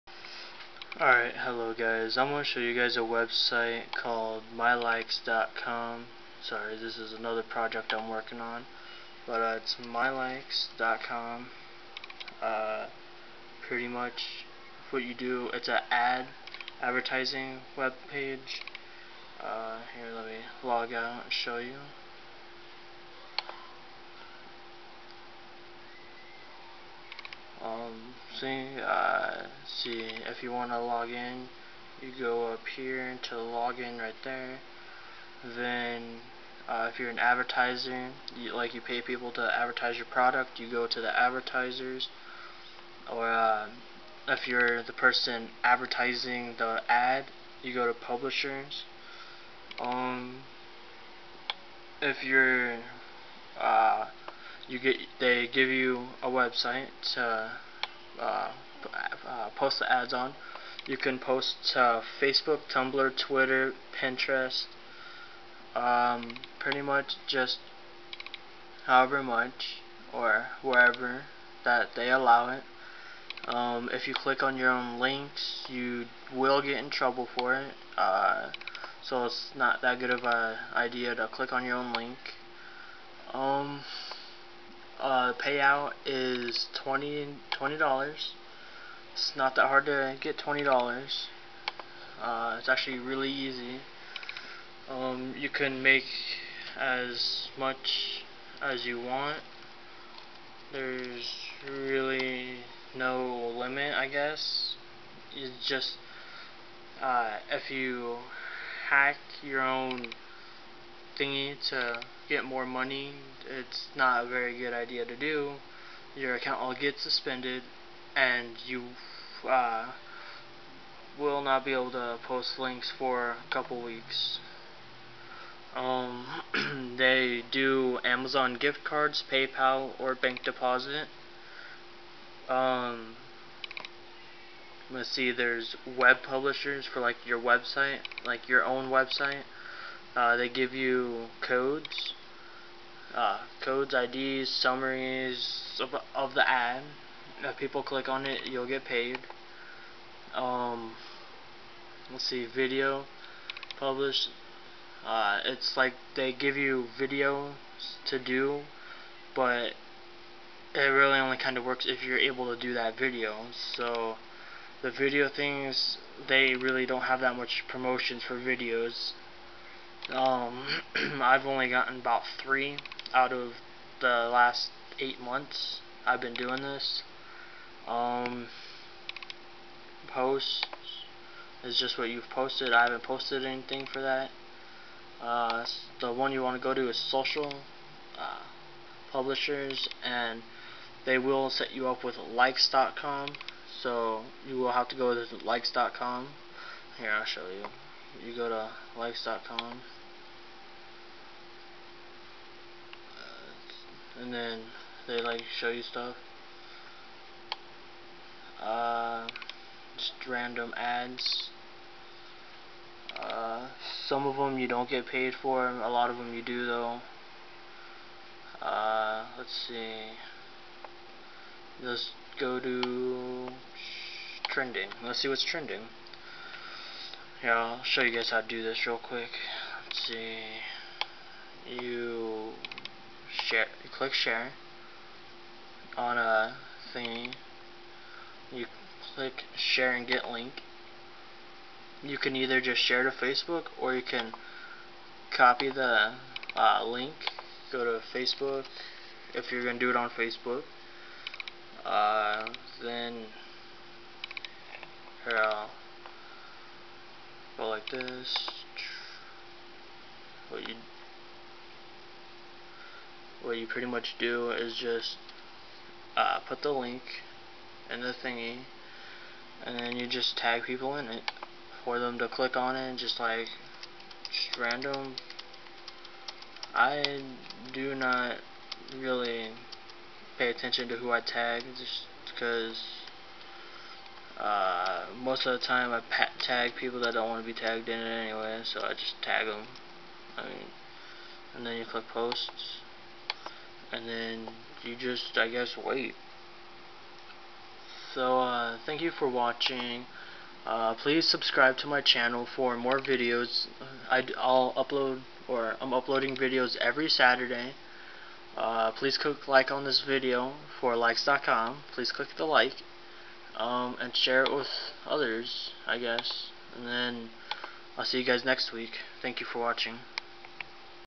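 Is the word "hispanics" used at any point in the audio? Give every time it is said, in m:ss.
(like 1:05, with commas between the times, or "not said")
not said.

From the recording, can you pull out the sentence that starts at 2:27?
If people click on it, you'll get paid.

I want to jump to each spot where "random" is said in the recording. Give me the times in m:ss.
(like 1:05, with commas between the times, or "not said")
3:30, 4:34.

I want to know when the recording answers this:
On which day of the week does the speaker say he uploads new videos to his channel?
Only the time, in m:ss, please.
5:07.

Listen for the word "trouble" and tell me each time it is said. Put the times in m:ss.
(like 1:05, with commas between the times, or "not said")
1:16.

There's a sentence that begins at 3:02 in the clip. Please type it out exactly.
I haven't posted anything for that.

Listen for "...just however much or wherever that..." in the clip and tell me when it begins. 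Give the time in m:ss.
1:07.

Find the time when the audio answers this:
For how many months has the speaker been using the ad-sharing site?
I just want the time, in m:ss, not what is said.
2:54.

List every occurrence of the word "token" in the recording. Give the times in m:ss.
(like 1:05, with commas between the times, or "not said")
not said.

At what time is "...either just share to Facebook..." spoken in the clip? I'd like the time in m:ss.
4:02.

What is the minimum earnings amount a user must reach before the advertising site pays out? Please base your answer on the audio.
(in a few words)
$20.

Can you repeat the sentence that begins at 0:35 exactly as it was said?
Then, uh, if you're an advertiser, you, like you pay people to advertise your product, you go to the advertisers.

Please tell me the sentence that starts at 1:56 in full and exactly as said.
Your account will get suspended, and you uh, will not be able to post links for a couple weeks.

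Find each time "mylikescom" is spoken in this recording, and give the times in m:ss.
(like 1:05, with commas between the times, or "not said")
0:04, 0:09.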